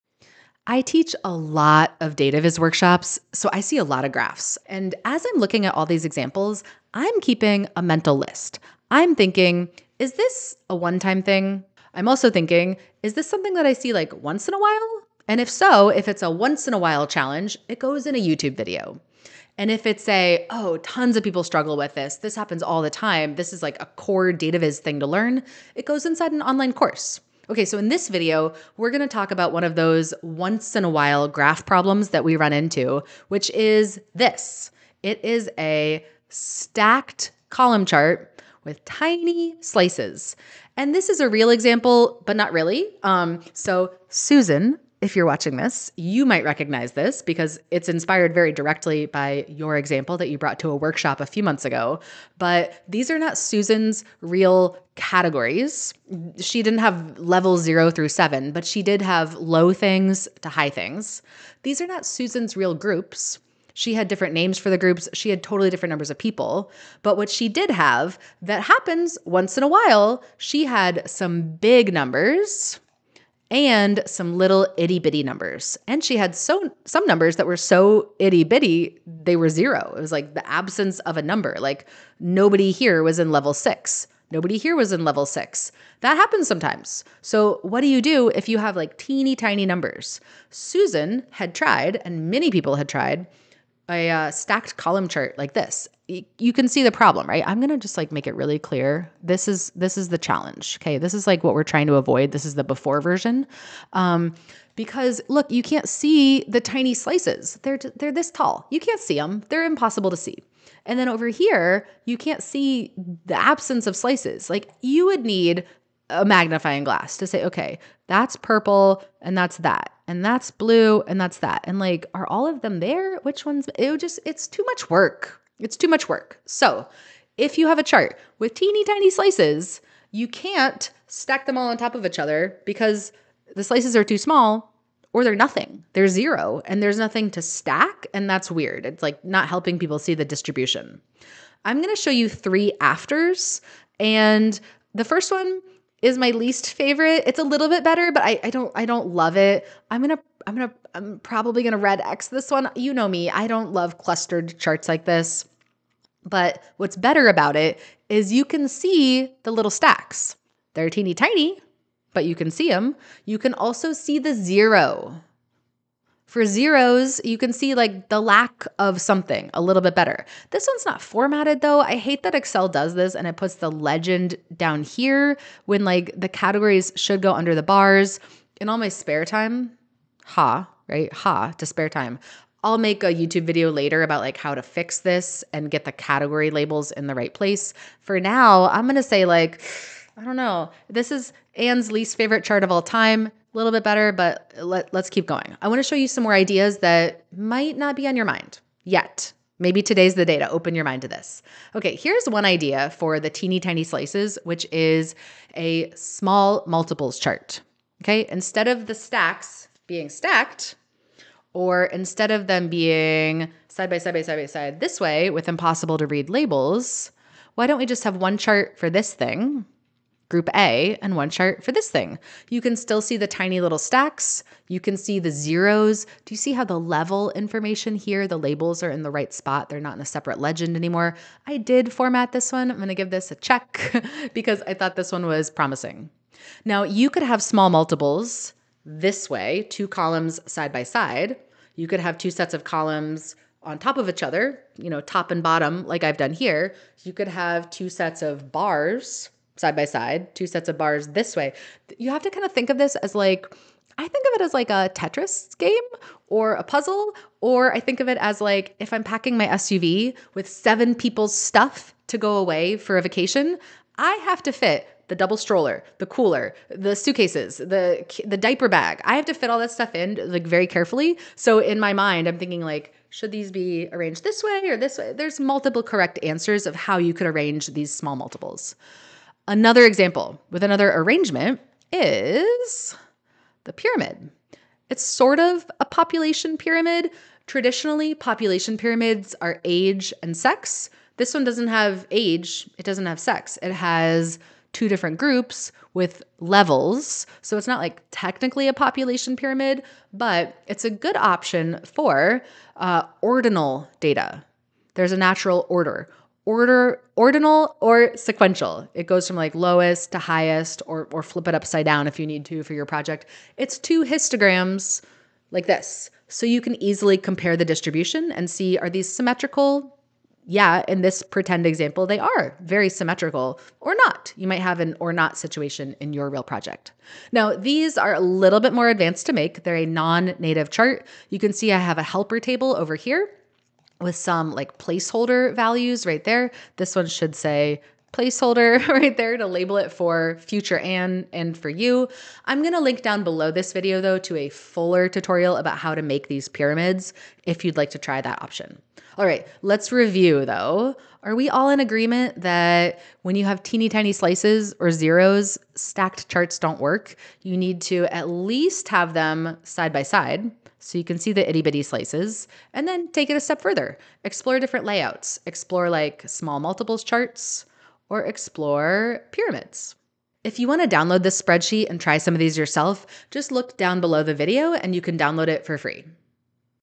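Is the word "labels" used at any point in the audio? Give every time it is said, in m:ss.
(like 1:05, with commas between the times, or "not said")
3:06, 3:36, 3:48, 5:39.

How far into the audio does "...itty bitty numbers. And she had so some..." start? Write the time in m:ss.
1:14.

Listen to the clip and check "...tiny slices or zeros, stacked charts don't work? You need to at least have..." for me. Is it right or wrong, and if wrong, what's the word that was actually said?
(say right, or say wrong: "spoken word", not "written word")
right.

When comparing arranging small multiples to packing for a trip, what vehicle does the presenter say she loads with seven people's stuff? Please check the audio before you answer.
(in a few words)
SUV.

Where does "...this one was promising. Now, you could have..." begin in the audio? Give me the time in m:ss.
3:54.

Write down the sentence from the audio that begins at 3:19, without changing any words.
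Maybe today's the day to open your mind to this.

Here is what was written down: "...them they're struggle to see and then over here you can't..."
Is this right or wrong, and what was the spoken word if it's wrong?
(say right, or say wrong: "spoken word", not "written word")
wrong: "impossible", not "struggle".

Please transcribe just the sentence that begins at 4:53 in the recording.
It has two different groups with levels.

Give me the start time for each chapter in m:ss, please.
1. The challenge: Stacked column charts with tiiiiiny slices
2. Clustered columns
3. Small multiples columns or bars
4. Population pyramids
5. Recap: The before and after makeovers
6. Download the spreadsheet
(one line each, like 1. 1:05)
1. 0:35
2. 2:21
3. 3:21
4. 4:41
5. 5:49
6. 6:10.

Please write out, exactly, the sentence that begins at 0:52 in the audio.
But these are not Susan's real categories.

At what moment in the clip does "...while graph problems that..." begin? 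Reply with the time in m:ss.
0:30.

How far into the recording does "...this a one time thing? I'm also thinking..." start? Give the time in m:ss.
0:10.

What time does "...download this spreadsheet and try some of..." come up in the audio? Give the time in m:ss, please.
6:10.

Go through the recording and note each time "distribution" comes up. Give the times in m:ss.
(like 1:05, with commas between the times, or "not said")
2:20, 5:17.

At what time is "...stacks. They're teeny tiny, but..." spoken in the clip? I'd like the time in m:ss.
2:39.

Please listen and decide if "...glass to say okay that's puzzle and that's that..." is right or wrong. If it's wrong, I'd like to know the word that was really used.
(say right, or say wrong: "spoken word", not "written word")
wrong: "purple", not "puzzle".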